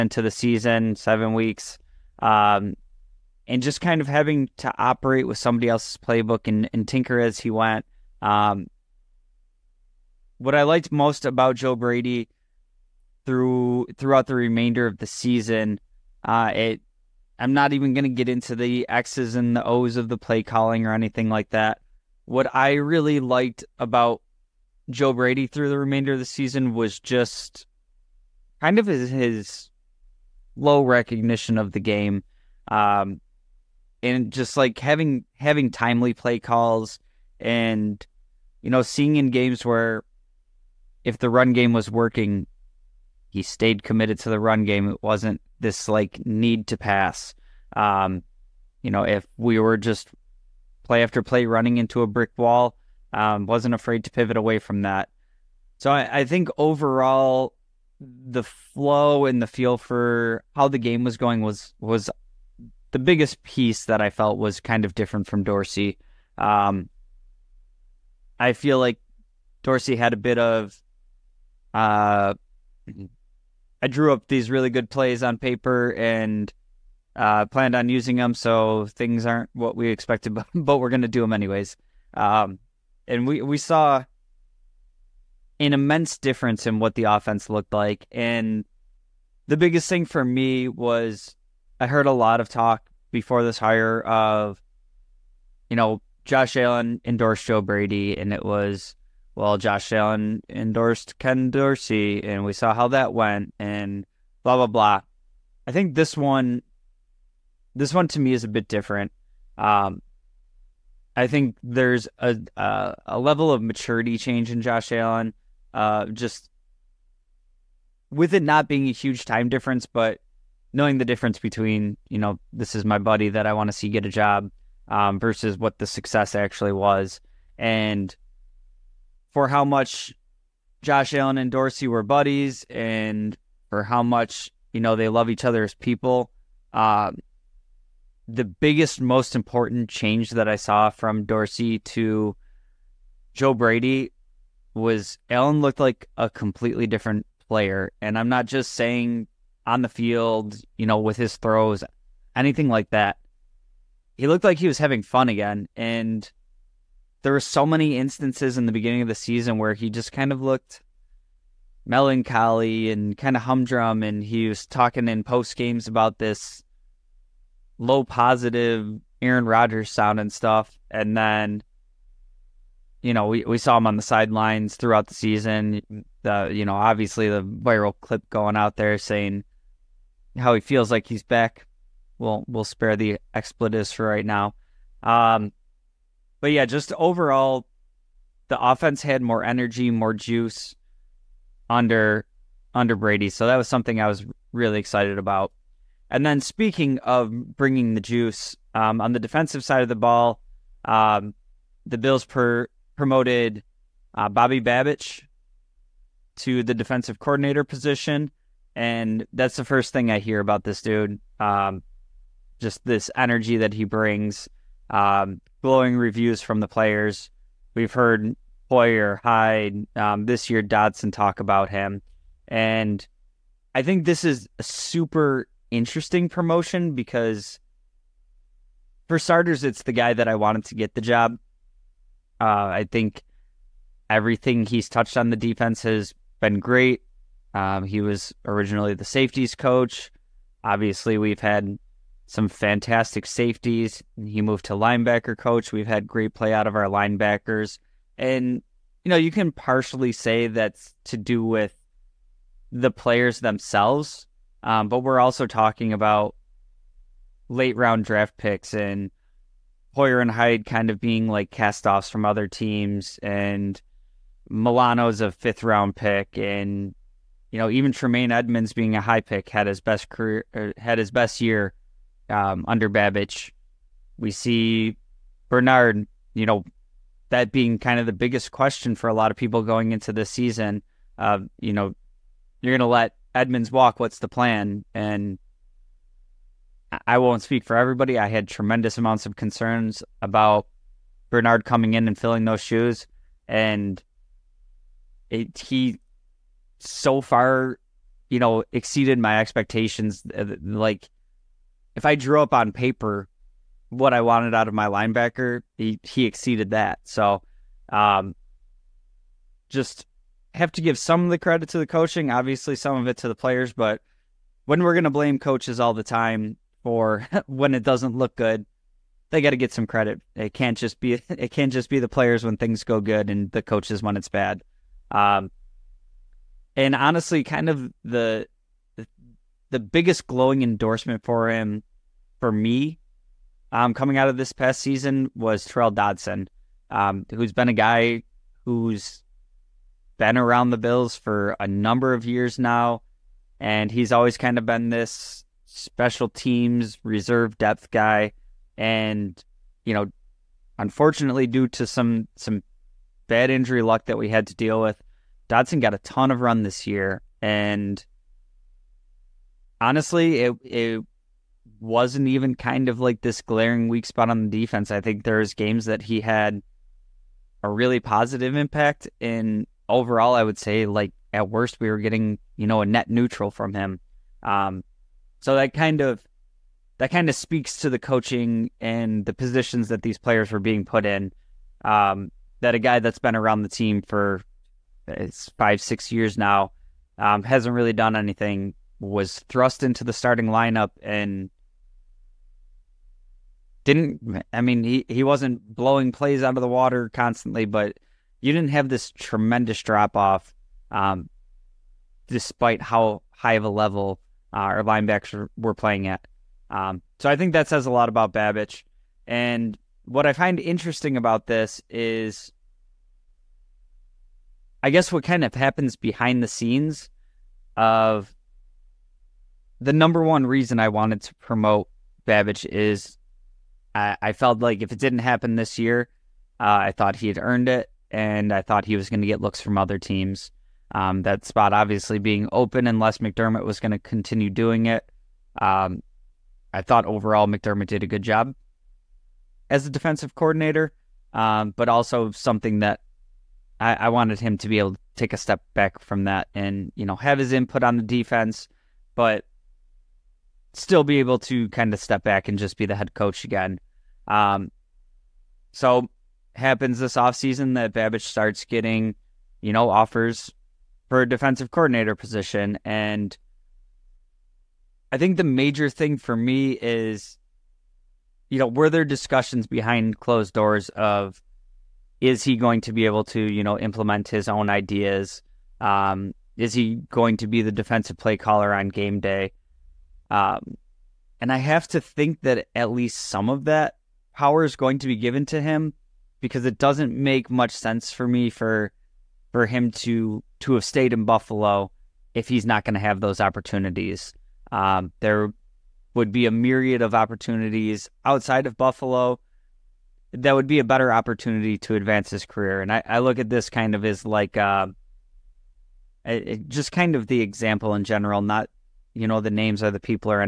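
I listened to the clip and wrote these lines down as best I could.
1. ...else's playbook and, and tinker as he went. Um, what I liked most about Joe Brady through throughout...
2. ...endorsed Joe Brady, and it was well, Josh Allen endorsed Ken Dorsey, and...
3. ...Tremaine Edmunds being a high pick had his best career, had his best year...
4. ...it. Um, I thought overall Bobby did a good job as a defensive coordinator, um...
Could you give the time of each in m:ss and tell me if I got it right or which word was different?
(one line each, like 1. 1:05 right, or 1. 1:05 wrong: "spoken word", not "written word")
1. 0:05 right
2. 1:37 right
3. 4:27 right
4. 7:14 wrong: "McDermott", not "Bobby".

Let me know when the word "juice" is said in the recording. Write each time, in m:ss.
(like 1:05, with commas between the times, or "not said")
3:10, 3:18.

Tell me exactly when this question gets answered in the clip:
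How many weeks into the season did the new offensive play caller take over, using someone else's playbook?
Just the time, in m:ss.
0:00.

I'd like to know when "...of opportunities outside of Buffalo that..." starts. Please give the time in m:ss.
8:17.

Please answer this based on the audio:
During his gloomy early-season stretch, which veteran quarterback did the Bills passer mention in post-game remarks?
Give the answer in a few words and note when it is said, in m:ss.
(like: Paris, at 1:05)
Aaron Rodgers, at 2:49.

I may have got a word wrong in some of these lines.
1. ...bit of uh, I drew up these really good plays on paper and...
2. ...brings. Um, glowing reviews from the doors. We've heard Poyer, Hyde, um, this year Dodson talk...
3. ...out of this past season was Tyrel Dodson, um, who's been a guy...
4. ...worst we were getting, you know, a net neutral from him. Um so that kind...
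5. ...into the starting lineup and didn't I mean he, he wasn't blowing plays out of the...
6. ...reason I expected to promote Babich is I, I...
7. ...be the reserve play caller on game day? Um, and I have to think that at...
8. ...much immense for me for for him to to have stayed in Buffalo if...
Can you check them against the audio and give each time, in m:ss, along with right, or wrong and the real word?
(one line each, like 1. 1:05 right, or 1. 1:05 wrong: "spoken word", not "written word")
1. 1:10 right
2. 3:33 wrong: "players", not "doors"
3. 5:34 right
4. 6:11 right
5. 6:29 right
6. 7:00 wrong: "wanted", not "expected"
7. 7:57 wrong: "defensive", not "reserve"
8. 8:07 wrong: "sense", not "immense".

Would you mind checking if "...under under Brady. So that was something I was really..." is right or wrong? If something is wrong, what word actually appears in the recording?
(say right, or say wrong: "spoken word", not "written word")
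right.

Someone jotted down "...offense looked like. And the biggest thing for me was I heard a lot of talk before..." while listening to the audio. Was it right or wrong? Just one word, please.
right.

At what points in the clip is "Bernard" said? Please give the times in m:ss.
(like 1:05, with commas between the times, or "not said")
4:35, 4:51.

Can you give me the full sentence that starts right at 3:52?
Uh, I think everything he's touched on the defense has been great.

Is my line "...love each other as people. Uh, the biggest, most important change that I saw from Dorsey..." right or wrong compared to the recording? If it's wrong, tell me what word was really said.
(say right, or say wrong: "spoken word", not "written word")
right.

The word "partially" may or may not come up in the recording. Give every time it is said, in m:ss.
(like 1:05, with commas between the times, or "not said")
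4:09.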